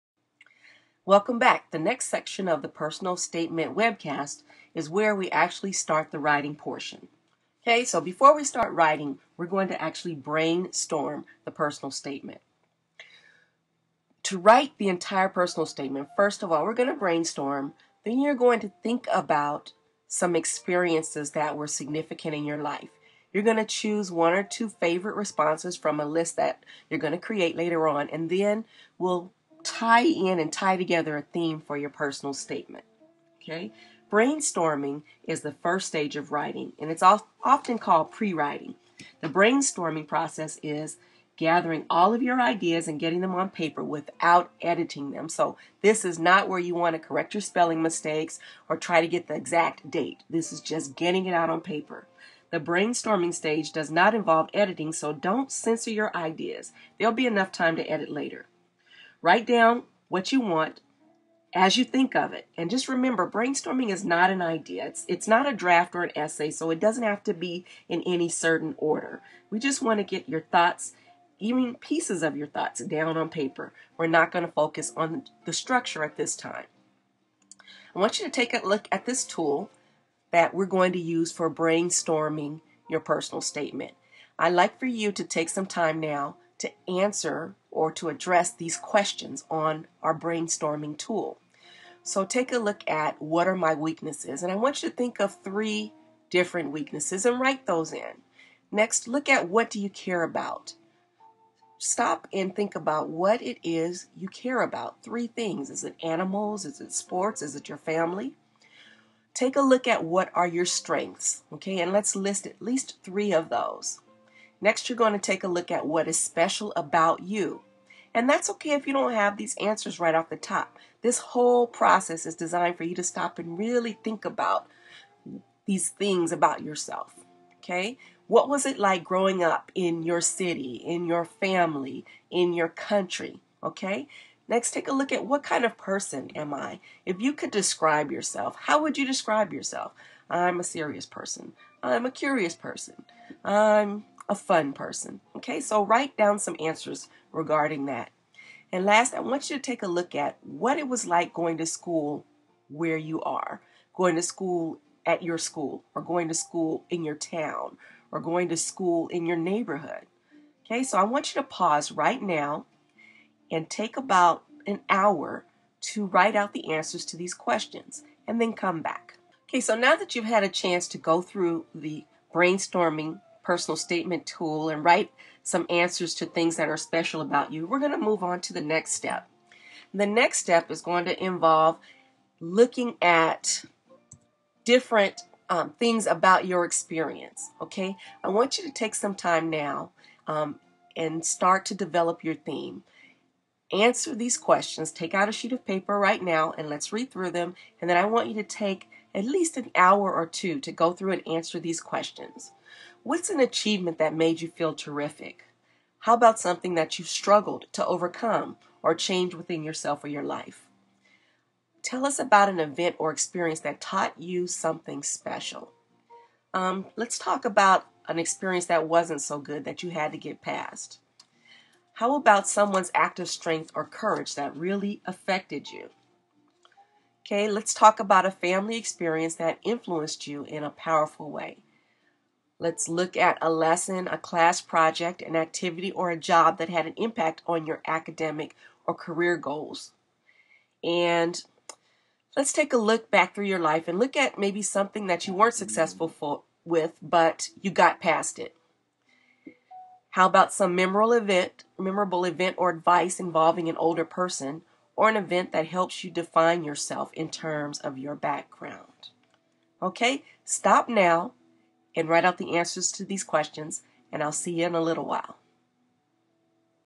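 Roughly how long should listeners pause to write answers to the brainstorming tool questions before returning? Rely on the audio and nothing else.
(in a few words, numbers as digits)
About an hour.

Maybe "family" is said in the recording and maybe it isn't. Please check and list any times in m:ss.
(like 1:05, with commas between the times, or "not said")
1:47, 2:11, 3:48.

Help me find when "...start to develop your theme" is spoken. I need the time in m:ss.
3:11.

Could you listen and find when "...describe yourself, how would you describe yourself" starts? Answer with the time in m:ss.
2:17.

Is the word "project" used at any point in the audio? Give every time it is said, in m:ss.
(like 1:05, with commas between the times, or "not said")
3:54.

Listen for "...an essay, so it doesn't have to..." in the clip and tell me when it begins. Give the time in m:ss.
1:06.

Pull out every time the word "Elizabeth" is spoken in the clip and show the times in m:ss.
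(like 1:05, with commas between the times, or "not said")
not said.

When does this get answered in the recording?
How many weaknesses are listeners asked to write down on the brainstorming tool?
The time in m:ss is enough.
1:35.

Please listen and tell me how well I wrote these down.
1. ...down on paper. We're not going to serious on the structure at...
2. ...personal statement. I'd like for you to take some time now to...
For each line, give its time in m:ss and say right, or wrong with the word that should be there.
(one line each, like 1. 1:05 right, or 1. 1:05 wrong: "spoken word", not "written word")
1. 1:12 wrong: "focus", not "serious"
2. 1:23 right.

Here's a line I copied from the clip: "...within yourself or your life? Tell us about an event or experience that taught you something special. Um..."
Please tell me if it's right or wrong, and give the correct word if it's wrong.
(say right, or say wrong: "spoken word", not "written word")
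right.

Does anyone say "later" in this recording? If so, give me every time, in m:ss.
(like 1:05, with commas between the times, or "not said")
0:27, 0:58.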